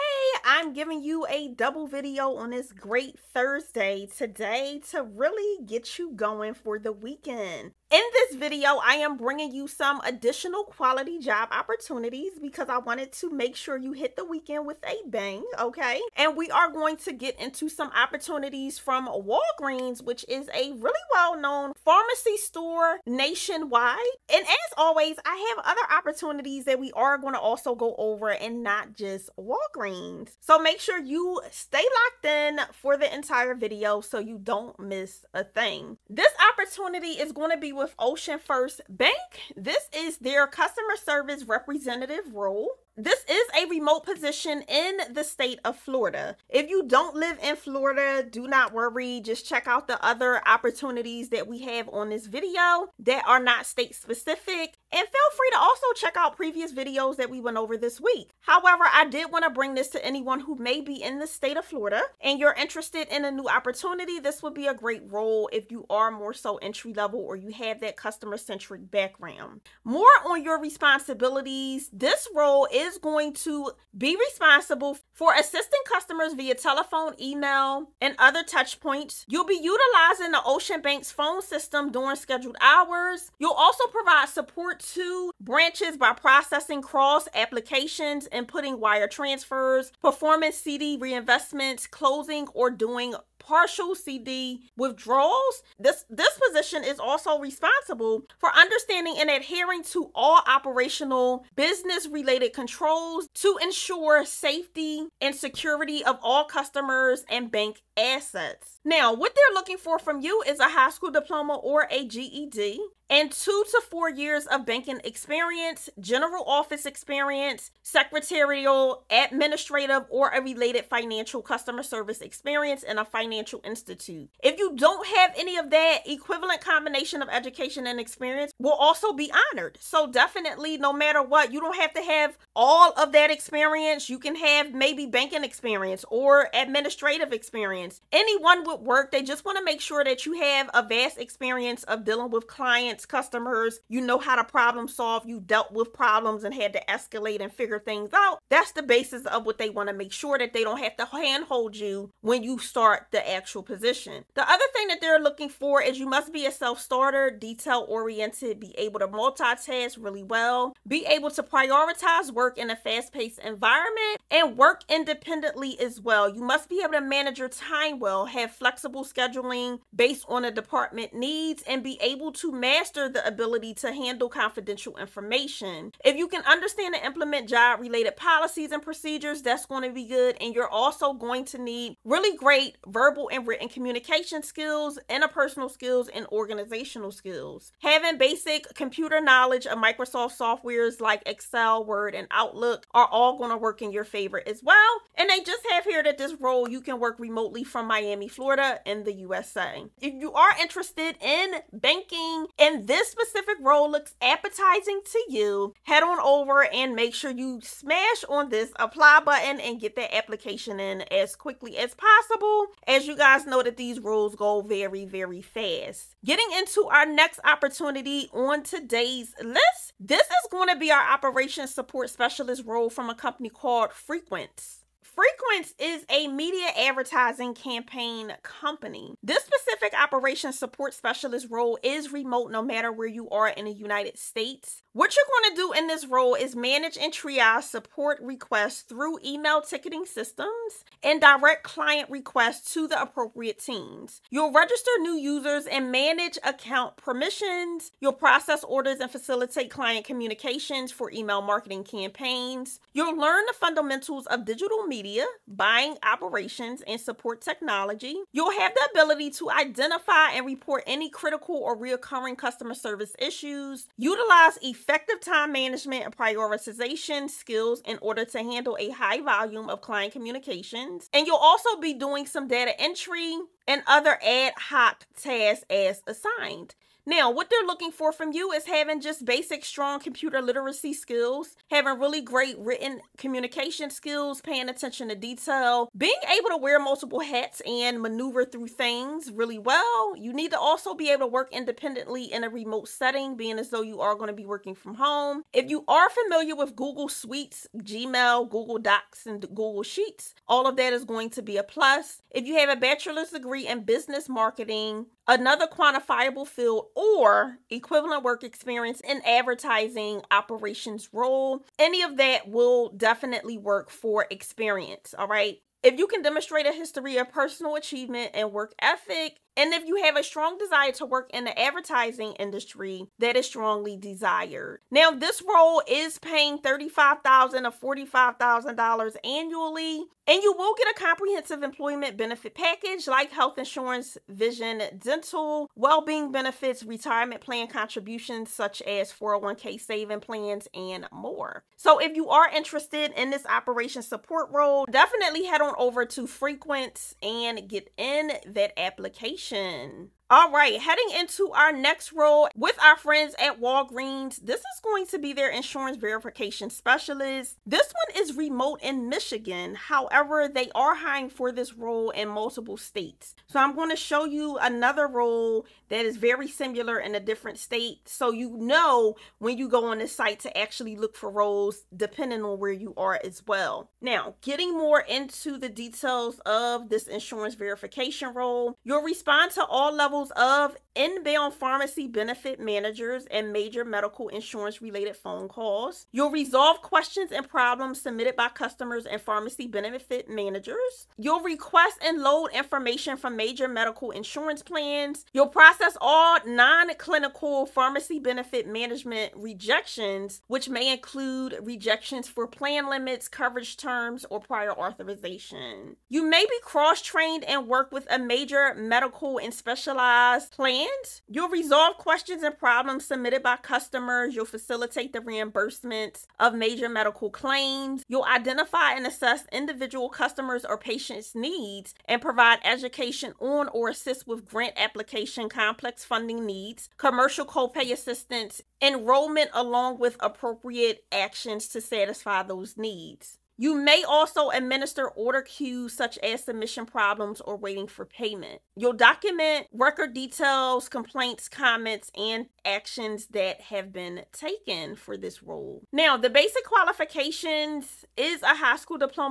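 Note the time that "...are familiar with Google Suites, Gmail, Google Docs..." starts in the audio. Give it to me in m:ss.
4:55.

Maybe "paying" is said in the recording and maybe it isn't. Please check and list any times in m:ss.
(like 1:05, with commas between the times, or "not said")
4:44, 5:26.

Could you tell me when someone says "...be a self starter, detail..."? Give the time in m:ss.
2:36.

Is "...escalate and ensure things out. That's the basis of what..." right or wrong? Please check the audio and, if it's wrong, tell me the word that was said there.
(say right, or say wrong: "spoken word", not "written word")
wrong: "figure", not "ensure".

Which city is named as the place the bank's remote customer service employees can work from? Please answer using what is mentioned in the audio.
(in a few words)
Miami.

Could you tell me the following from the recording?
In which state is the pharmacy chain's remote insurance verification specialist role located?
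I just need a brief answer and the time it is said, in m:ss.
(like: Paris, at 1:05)
Michigan, at 5:59.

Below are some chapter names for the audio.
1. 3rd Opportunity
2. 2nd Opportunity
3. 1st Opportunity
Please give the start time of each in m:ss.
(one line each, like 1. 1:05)
1. 5:50
2. 3:36
3. 0:36.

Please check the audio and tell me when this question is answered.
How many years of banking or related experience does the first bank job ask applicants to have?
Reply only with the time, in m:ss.
1:53.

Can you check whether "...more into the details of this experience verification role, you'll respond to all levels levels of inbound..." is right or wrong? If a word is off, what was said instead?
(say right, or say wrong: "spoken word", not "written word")
wrong: "insurance", not "experience".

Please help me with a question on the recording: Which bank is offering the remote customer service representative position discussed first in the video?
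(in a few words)
Ocean First Bank.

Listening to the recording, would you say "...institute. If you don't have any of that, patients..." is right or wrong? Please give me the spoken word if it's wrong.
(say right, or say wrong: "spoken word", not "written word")
wrong: "equivalent", not "patients".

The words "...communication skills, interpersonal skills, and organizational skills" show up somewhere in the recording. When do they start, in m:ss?
3:03.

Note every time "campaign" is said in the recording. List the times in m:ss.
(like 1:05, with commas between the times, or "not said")
3:47, 4:11.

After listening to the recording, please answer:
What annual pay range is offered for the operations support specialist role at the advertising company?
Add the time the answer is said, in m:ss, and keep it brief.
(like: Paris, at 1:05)
$35,000 to $45,000, at 5:26.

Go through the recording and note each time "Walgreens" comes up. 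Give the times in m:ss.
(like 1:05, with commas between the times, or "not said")
0:19, 0:29, 5:53.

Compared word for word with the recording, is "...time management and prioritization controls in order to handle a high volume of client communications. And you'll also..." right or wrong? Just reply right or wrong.
wrong.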